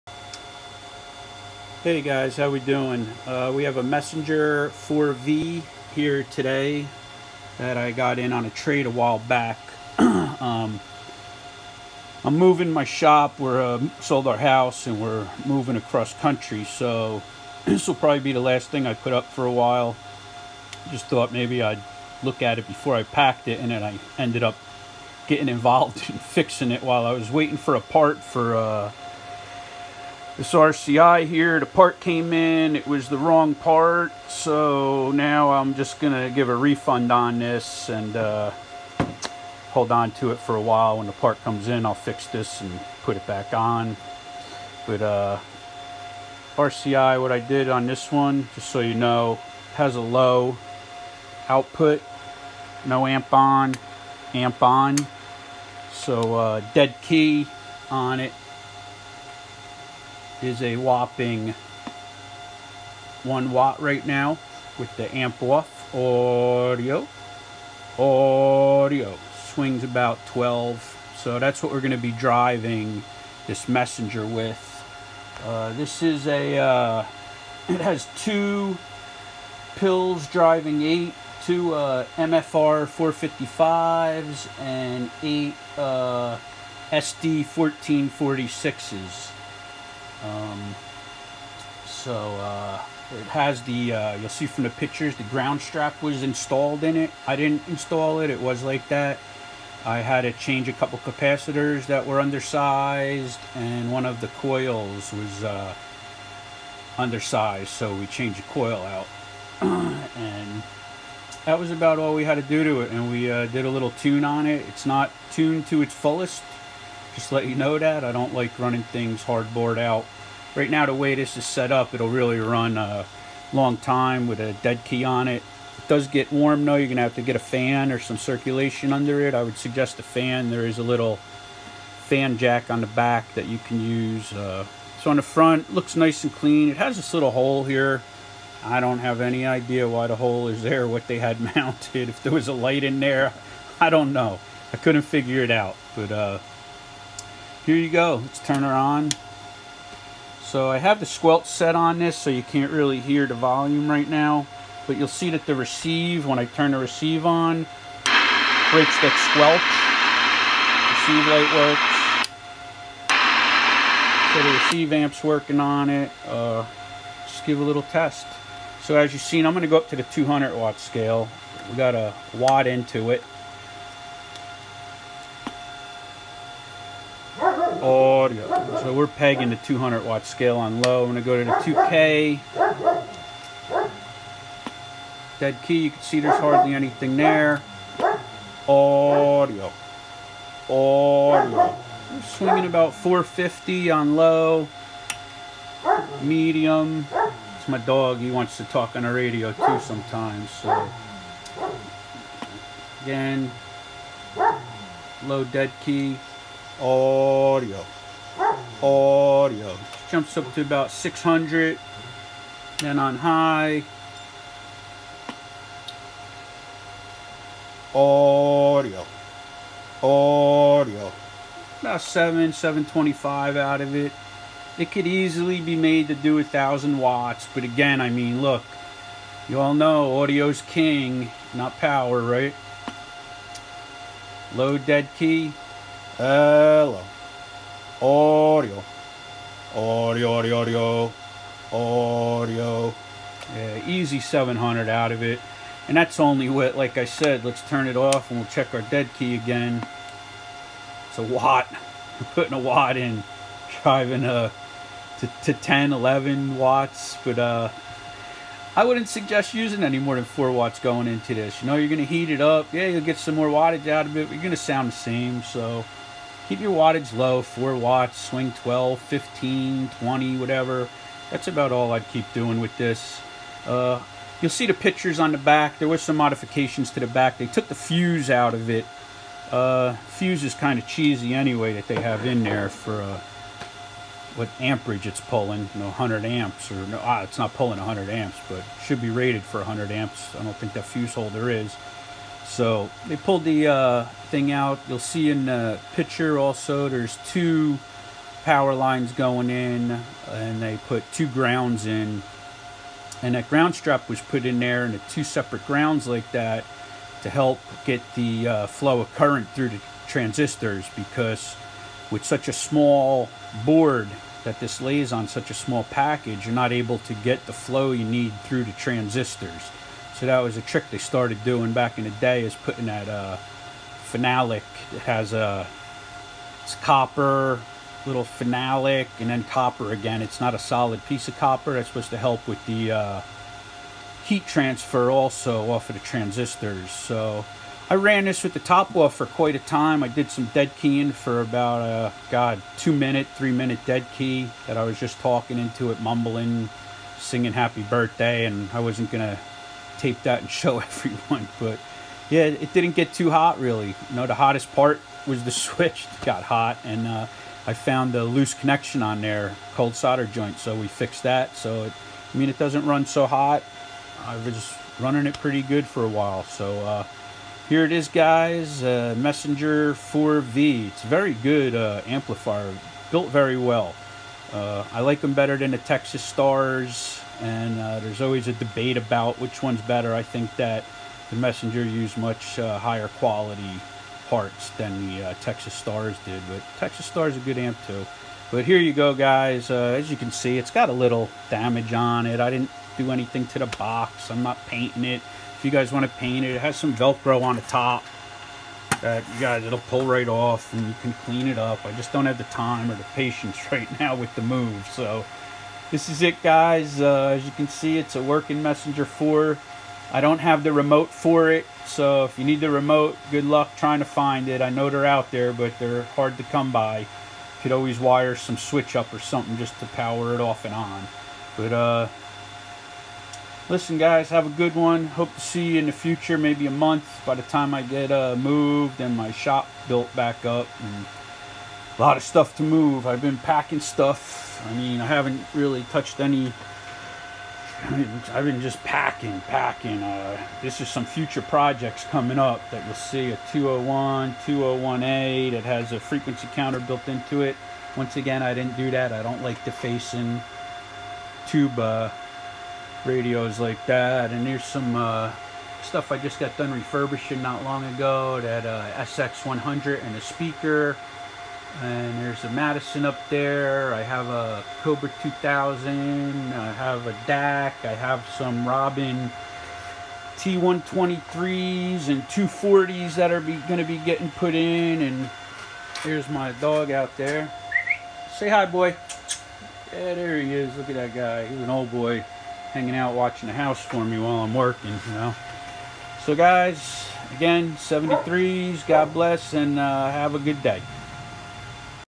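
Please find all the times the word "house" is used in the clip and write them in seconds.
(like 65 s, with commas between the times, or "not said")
14 s, 483 s.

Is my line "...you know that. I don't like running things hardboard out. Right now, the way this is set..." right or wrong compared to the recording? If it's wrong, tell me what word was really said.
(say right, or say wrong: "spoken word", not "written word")
right.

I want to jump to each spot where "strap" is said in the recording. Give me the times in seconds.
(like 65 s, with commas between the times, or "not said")
95 s, 303 s.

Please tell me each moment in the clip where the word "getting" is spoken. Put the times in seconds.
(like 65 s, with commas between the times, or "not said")
25 s, 473 s.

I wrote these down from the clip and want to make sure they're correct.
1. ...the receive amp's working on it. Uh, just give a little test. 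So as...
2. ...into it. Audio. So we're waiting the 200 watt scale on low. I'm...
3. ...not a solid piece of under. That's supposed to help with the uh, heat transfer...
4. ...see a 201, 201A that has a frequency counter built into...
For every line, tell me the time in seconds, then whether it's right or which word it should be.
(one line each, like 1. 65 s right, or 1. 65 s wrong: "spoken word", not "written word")
1. 164 s right
2. 172 s wrong: "pegging", not "waiting"
3. 330 s wrong: "copper", not "under"
4. 442 s right.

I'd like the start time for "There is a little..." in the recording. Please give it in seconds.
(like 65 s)
130 s.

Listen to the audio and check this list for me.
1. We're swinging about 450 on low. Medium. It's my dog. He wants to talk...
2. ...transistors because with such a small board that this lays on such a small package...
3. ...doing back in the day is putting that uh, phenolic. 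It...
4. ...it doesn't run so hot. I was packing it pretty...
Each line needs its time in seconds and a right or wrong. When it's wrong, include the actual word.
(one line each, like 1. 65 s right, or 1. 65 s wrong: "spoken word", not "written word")
1. 192 s right
2. 310 s right
3. 321 s right
4. 362 s wrong: "running", not "packing".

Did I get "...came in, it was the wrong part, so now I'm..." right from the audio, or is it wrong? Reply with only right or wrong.
right.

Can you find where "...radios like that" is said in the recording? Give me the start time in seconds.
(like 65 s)
453 s.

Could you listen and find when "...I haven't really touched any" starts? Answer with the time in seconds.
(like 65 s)
435 s.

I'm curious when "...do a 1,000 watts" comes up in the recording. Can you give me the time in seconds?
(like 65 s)
226 s.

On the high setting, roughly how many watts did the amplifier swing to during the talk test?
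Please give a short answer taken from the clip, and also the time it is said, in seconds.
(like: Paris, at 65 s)
725, at 222 s.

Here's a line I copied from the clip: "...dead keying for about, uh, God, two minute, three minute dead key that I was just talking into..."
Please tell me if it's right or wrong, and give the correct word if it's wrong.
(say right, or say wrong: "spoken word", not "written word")
right.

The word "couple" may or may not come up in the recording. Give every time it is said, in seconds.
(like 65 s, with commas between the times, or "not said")
100 s.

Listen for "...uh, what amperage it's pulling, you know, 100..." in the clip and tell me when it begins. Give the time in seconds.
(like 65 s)
283 s.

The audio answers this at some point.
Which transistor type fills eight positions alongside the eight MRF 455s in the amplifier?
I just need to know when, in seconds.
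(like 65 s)
86 s.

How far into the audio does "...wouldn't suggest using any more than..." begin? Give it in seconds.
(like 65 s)
258 s.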